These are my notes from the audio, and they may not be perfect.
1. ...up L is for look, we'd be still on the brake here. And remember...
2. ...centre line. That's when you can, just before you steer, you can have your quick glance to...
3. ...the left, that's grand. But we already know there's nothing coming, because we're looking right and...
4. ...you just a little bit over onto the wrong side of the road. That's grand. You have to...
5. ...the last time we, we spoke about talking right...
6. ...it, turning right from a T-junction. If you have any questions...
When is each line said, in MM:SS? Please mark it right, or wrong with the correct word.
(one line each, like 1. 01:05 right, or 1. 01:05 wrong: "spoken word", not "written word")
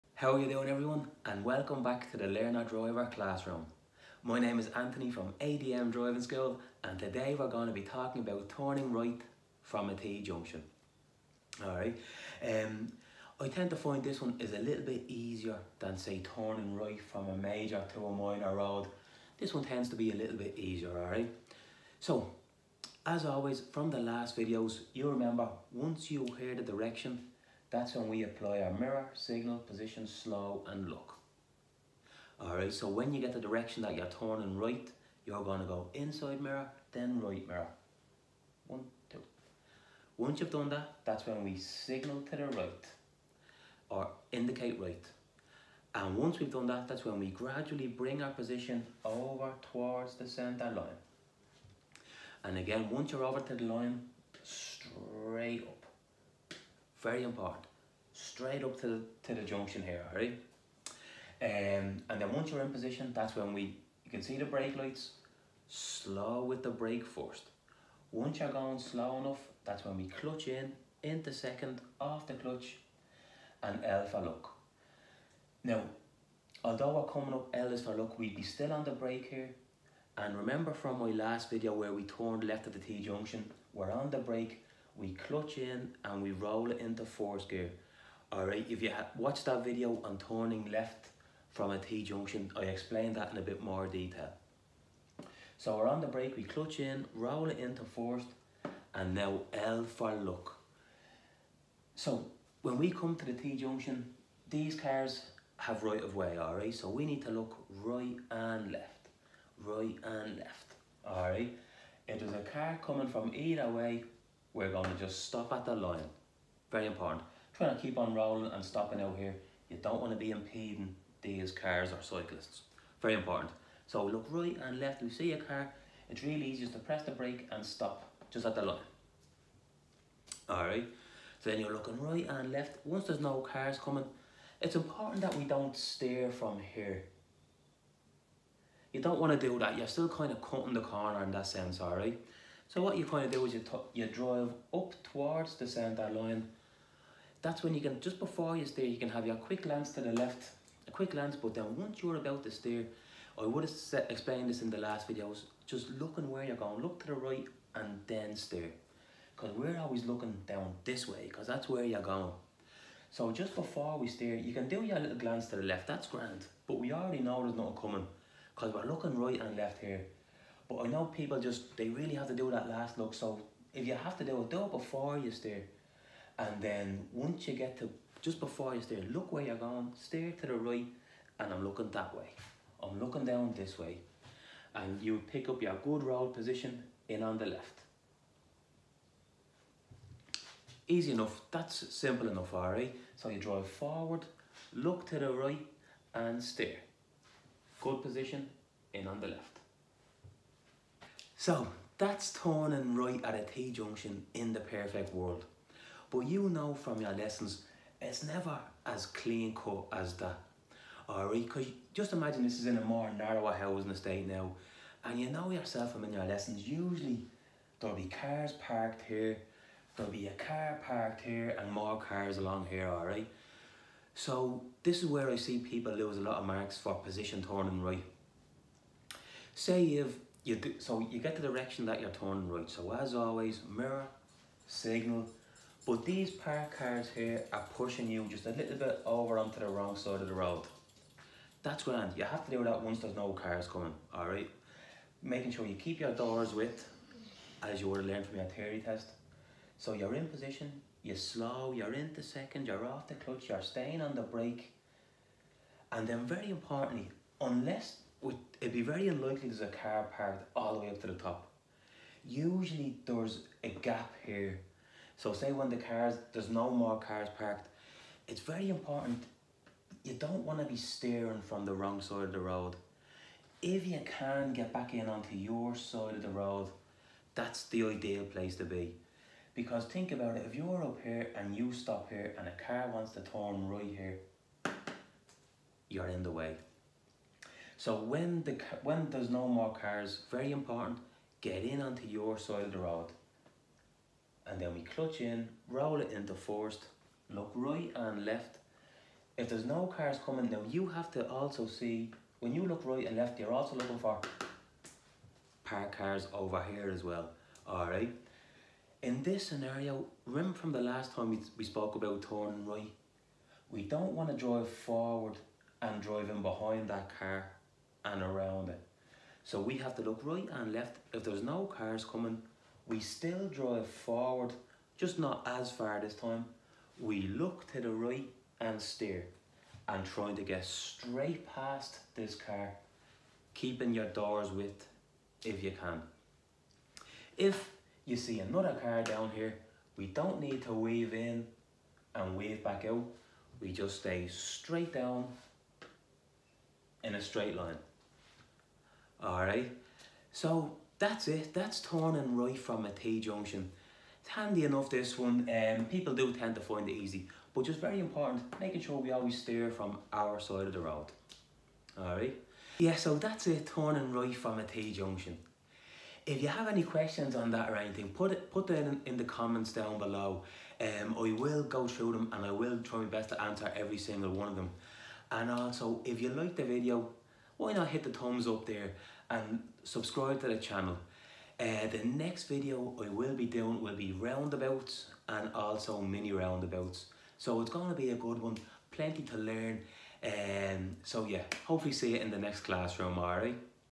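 1. 01:17 right
2. 02:25 right
3. 02:45 right
4. 03:58 right
5. 05:10 wrong: "turning", not "talking"
6. 06:03 right.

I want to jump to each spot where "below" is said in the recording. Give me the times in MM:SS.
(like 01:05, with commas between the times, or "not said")
06:09.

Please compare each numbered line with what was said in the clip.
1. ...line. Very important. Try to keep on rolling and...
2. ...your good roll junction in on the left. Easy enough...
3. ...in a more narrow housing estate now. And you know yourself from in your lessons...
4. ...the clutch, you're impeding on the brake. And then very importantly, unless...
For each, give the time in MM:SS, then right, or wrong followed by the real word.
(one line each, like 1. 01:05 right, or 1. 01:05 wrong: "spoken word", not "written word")
1. 01:55 right
2. 03:05 wrong: "position", not "junction"
3. 03:32 right
4. 04:13 wrong: "staying", not "impeding".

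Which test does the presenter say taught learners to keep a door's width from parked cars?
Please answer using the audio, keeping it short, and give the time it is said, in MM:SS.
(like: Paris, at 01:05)
theory test, at 04:08.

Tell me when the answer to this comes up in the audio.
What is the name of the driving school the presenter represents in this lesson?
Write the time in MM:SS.
00:05.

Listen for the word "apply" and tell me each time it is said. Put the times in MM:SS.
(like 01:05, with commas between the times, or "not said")
00:28.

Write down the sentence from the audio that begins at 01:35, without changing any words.
So we're on the brake, we clutch in, roll it into fourth, and now L for look.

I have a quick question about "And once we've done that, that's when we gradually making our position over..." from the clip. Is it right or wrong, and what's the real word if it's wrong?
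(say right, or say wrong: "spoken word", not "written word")
wrong: "bring", not "making".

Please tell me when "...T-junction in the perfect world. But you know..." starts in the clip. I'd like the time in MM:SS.
03:23.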